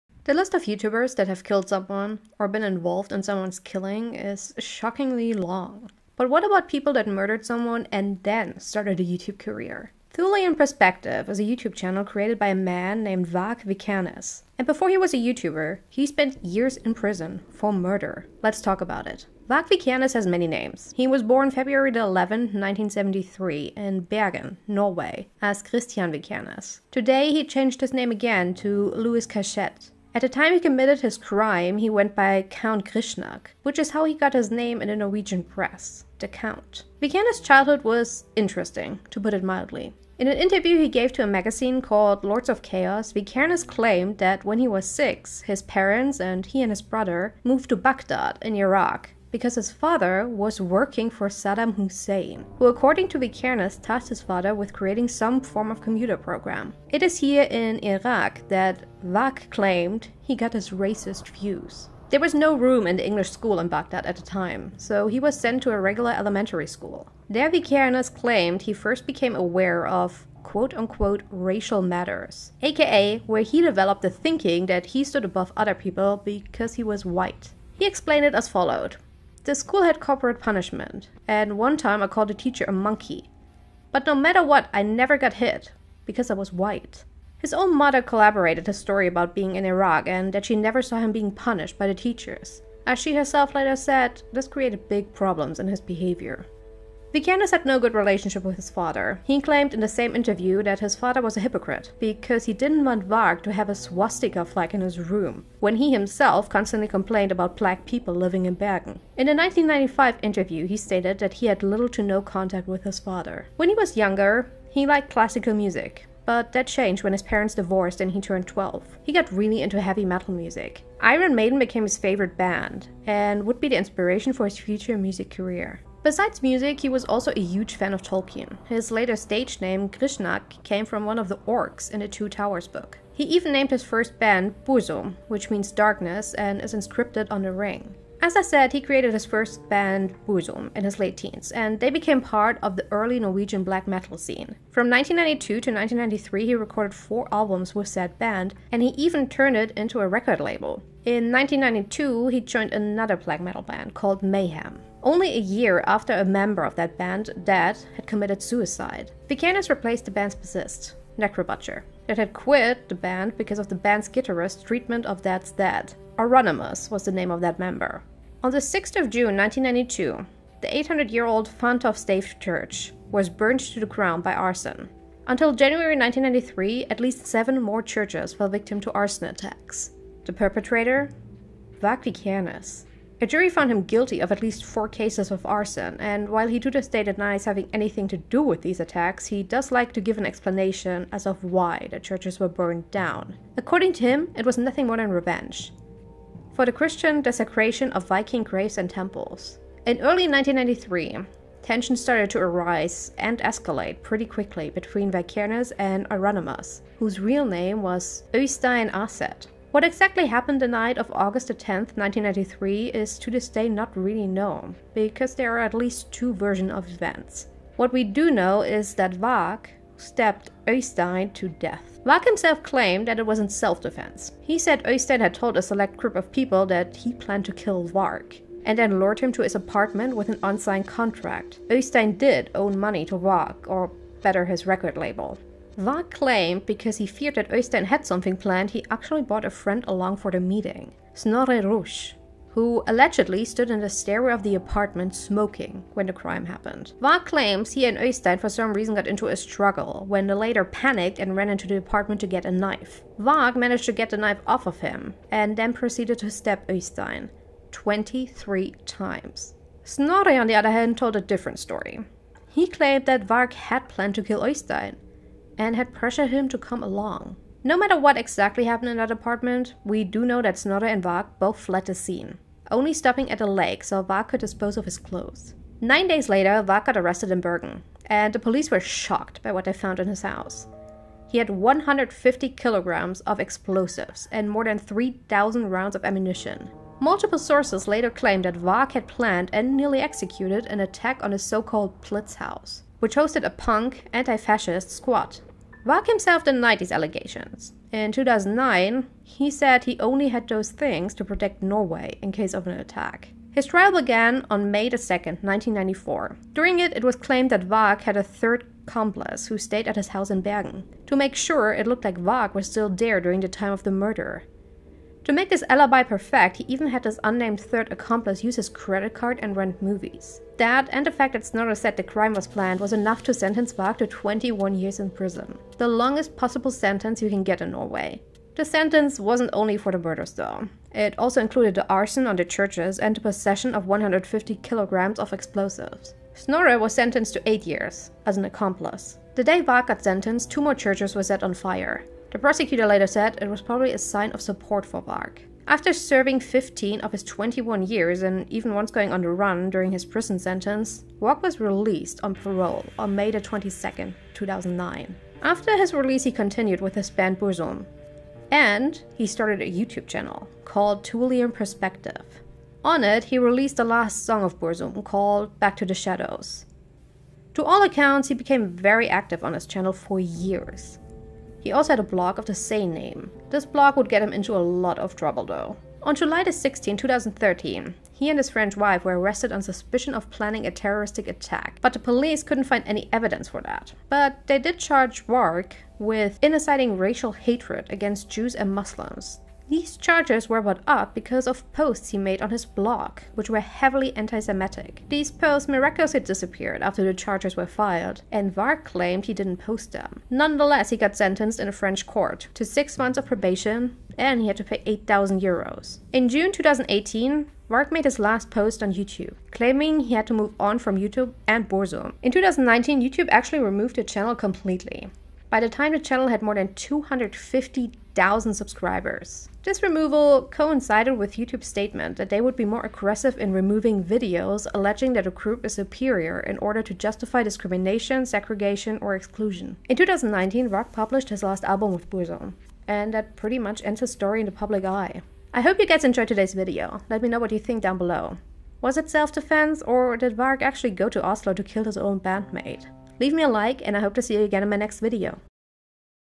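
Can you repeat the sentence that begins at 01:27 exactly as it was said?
His own mother corroborated his story about being in Iraq and that she never saw him being punished by the teachers.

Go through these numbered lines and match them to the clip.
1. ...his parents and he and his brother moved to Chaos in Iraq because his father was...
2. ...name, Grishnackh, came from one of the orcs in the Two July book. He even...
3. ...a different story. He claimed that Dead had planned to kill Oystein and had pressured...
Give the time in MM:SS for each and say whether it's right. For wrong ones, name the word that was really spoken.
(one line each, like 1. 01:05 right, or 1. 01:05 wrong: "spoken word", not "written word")
1. 00:45 wrong: "Baghdad", not "Chaos"
2. 02:09 wrong: "Towers", not "July"
3. 04:21 wrong: "Varg", not "Dead".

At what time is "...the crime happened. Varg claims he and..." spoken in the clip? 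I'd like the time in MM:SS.
04:06.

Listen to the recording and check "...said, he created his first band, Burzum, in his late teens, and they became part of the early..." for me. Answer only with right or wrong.
right.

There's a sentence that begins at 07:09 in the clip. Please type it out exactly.
In 2019, Rock published his last album with Burzum, and that pretty much ends his story in the public eye.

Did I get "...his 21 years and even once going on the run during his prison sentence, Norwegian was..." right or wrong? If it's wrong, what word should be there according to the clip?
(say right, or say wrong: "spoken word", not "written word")
wrong: "Varg", not "Norwegian".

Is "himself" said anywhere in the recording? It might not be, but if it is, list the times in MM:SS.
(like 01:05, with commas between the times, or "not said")
01:45, 03:42, 04:56.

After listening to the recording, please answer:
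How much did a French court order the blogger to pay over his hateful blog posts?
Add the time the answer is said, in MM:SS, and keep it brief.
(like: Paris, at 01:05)
8,000 euros, at 06:44.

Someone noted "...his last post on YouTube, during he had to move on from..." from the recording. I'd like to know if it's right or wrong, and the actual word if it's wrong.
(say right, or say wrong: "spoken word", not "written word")
wrong: "claiming", not "during".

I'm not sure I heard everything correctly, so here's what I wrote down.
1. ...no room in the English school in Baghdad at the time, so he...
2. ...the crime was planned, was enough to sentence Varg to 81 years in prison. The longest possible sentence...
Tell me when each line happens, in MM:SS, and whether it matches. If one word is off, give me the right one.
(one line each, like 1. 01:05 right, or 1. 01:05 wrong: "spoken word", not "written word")
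1. 01:02 right
2. 05:21 wrong: "21", not "81".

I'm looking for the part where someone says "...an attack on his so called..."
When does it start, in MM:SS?
04:50.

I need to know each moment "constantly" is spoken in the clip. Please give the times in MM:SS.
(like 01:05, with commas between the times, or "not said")
01:46.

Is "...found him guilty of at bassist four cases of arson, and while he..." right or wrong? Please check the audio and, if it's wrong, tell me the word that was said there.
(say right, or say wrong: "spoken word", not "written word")
wrong: "least", not "bassist".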